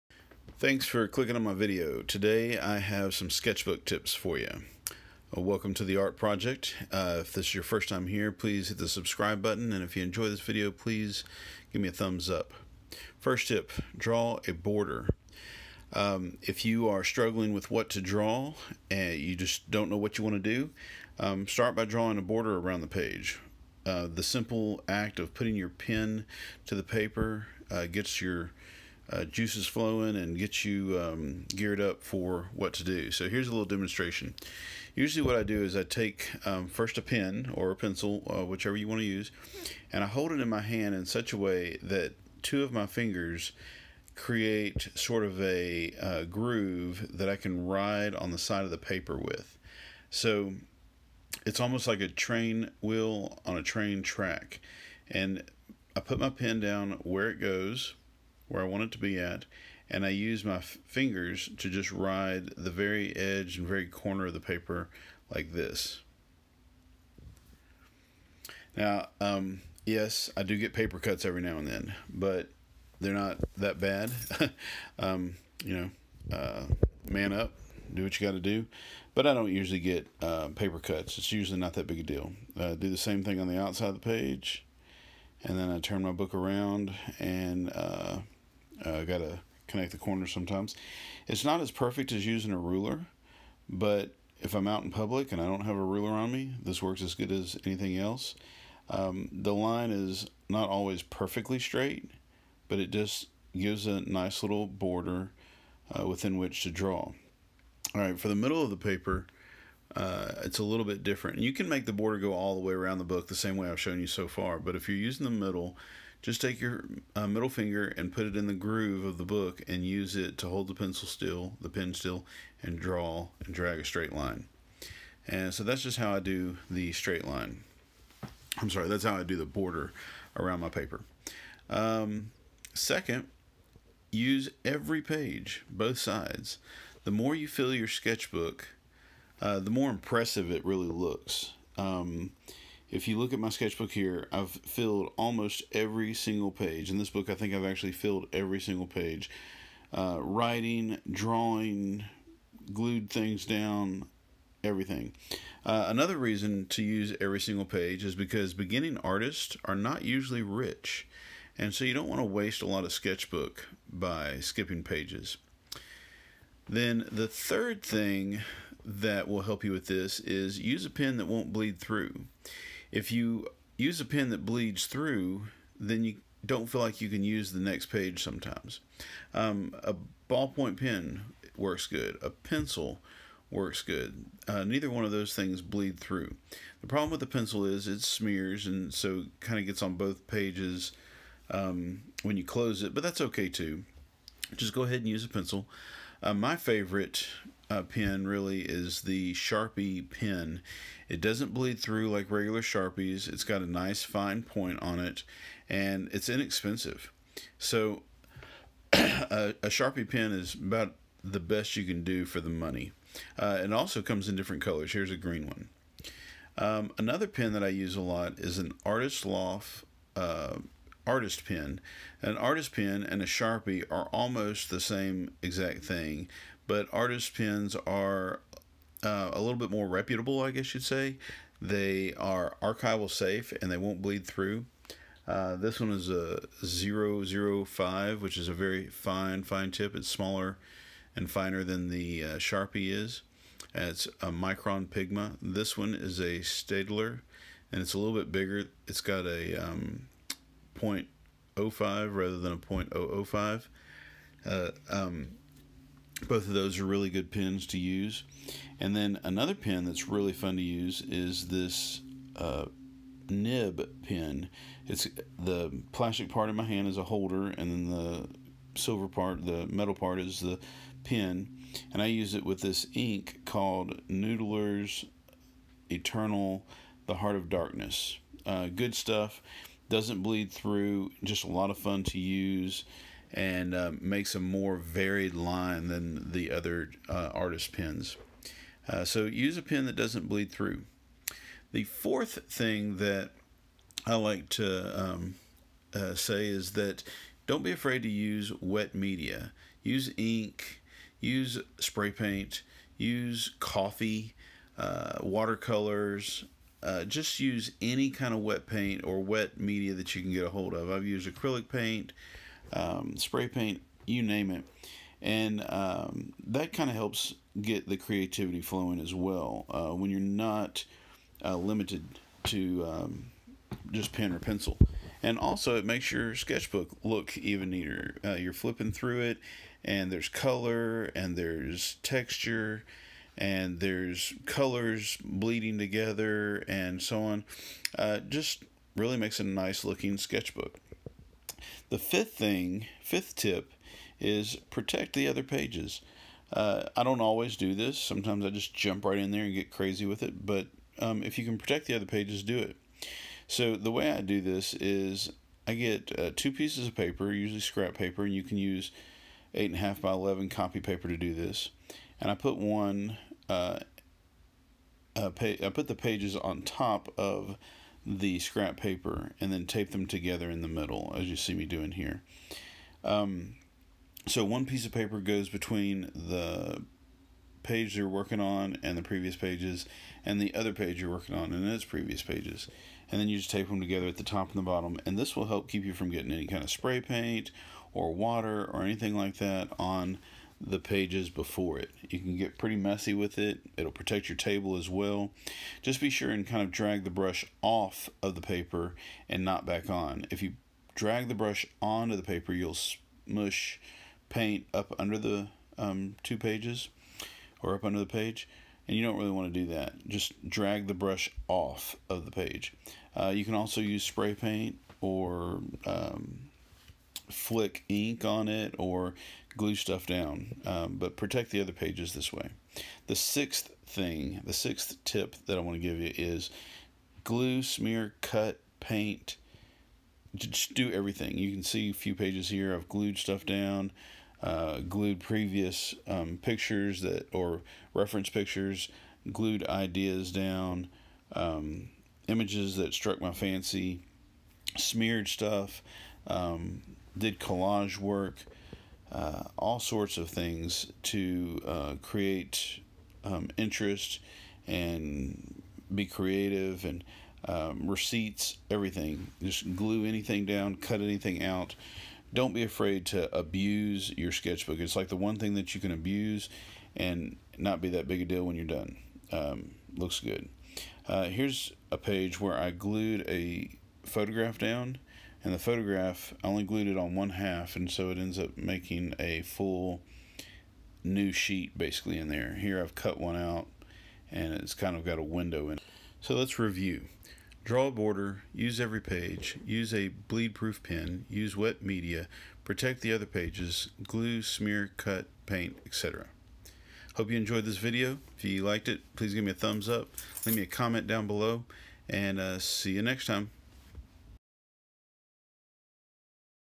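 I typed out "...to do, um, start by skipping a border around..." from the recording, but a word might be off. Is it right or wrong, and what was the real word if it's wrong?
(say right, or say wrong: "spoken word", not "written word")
wrong: "drawing", not "skipping".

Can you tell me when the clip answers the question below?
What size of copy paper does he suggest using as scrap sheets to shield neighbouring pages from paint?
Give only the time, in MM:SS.
05:59.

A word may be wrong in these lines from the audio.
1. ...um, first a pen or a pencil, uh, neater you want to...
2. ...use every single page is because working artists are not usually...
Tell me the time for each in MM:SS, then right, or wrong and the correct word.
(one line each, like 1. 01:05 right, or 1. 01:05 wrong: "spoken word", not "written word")
1. 00:36 wrong: "whichever", not "neater"
2. 02:36 wrong: "beginning", not "working".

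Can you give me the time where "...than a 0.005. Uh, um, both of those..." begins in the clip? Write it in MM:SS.
04:12.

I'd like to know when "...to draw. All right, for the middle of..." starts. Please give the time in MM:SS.
01:46.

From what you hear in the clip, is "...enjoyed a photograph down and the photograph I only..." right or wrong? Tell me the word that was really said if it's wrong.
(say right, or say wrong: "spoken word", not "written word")
wrong: "glued", not "enjoyed".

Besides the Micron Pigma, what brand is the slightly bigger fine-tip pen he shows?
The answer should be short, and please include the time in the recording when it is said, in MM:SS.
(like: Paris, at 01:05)
Staedtler, at 04:06.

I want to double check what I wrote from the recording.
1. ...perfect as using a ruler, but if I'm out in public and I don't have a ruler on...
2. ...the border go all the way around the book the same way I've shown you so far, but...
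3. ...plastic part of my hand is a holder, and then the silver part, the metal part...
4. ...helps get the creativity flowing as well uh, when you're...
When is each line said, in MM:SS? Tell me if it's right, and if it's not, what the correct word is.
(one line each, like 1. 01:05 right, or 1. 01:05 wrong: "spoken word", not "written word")
1. 01:31 right
2. 01:51 right
3. 04:25 right
4. 05:16 right.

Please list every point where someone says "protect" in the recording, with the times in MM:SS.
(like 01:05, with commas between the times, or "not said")
05:44, 05:51, 06:33, 07:01, 08:12.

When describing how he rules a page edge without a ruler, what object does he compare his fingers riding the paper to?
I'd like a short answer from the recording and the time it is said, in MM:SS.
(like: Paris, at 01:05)
Train wheel, at 00:52.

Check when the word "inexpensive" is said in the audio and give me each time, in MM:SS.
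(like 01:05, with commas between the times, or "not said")
03:26.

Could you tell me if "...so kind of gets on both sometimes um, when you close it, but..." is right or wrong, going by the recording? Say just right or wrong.
wrong.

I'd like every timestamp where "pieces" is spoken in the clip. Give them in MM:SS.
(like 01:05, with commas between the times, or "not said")
05:56, 06:14.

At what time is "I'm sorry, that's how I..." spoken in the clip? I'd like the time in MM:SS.
02:08.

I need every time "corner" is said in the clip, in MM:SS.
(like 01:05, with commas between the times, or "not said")
01:03, 01:29.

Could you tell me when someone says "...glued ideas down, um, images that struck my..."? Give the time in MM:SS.
07:19.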